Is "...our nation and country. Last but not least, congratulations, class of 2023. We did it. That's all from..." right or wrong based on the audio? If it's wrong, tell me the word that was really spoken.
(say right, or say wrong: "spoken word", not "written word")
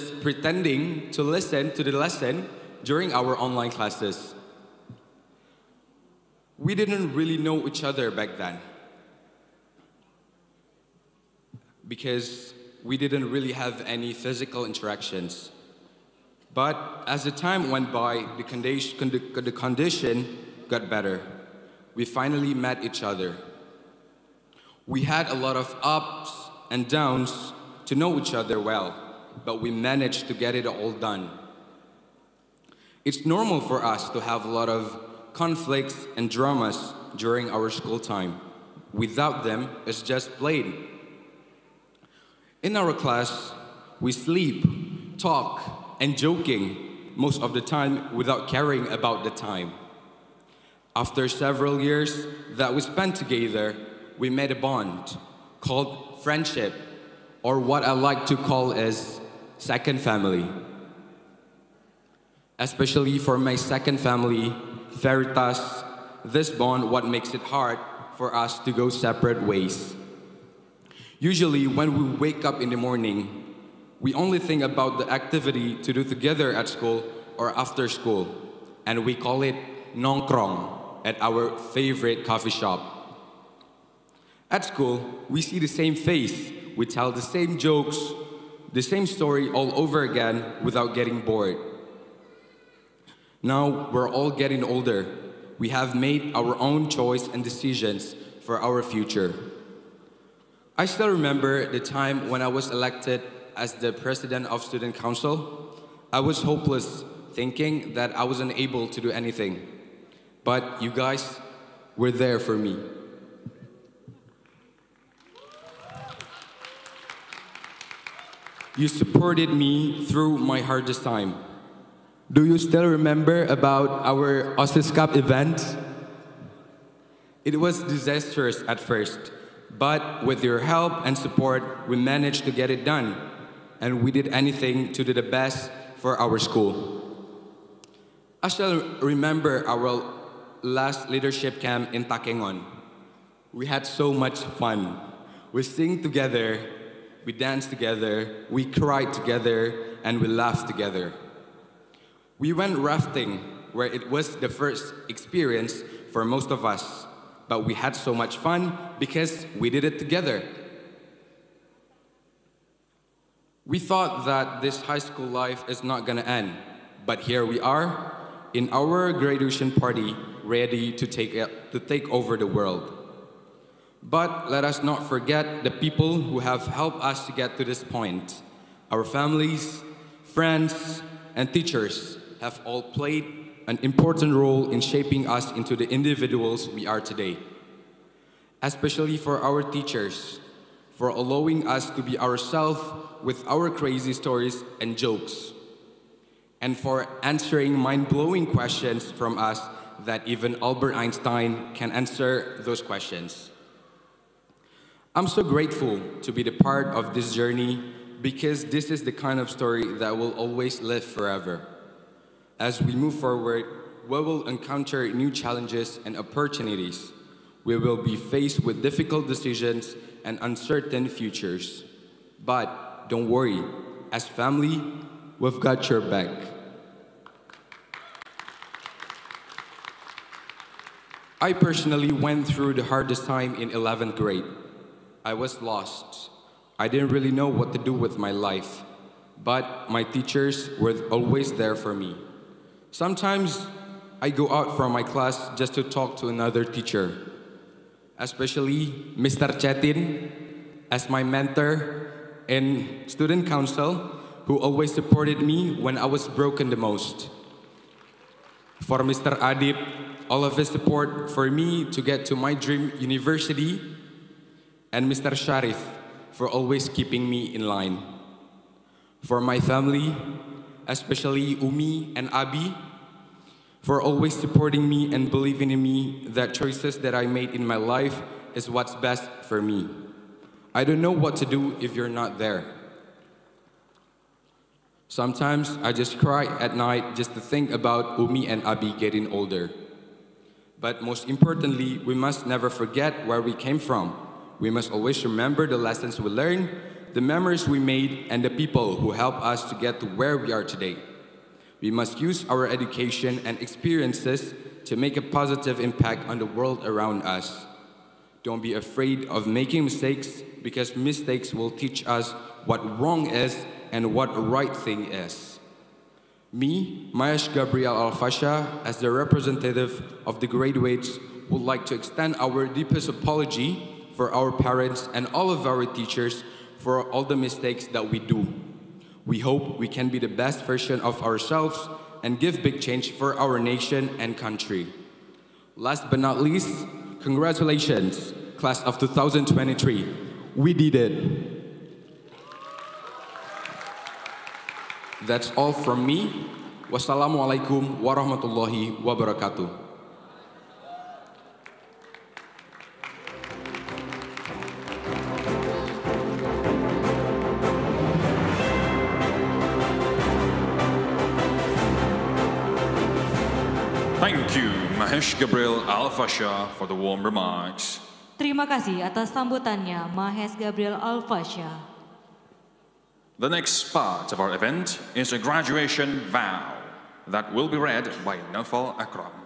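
right.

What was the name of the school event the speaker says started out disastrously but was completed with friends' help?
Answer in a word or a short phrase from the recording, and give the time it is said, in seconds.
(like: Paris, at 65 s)
OSIS Cup, at 124 s.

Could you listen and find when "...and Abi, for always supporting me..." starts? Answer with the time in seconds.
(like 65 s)
272 s.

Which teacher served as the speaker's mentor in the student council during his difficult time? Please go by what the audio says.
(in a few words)
Mr. Chetin.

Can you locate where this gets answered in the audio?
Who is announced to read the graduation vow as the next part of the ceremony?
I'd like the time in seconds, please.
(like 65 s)
378 s.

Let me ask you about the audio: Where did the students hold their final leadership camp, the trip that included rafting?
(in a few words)
Takengon.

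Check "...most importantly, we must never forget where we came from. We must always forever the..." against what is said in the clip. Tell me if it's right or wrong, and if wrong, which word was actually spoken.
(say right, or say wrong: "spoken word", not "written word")
wrong: "remember", not "forever".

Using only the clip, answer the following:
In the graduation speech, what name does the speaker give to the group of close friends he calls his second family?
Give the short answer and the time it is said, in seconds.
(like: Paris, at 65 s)
Veritas, at 64 s.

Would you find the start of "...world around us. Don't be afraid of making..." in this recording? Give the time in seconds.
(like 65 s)
306 s.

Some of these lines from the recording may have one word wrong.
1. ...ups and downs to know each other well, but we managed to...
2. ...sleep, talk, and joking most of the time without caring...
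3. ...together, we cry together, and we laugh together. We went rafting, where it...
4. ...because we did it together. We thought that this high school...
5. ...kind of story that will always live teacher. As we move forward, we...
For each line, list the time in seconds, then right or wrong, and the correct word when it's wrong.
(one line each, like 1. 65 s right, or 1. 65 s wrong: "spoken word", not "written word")
1. 25 s right
2. 44 s right
3. 147 s right
4. 158 s right
5. 209 s wrong: "forever", not "teacher".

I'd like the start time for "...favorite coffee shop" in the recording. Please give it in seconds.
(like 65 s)
81 s.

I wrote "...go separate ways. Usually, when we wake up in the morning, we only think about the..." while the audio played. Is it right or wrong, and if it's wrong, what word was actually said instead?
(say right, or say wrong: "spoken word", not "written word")
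right.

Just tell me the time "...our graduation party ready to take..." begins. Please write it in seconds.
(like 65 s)
168 s.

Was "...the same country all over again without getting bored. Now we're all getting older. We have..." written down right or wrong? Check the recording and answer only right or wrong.
wrong.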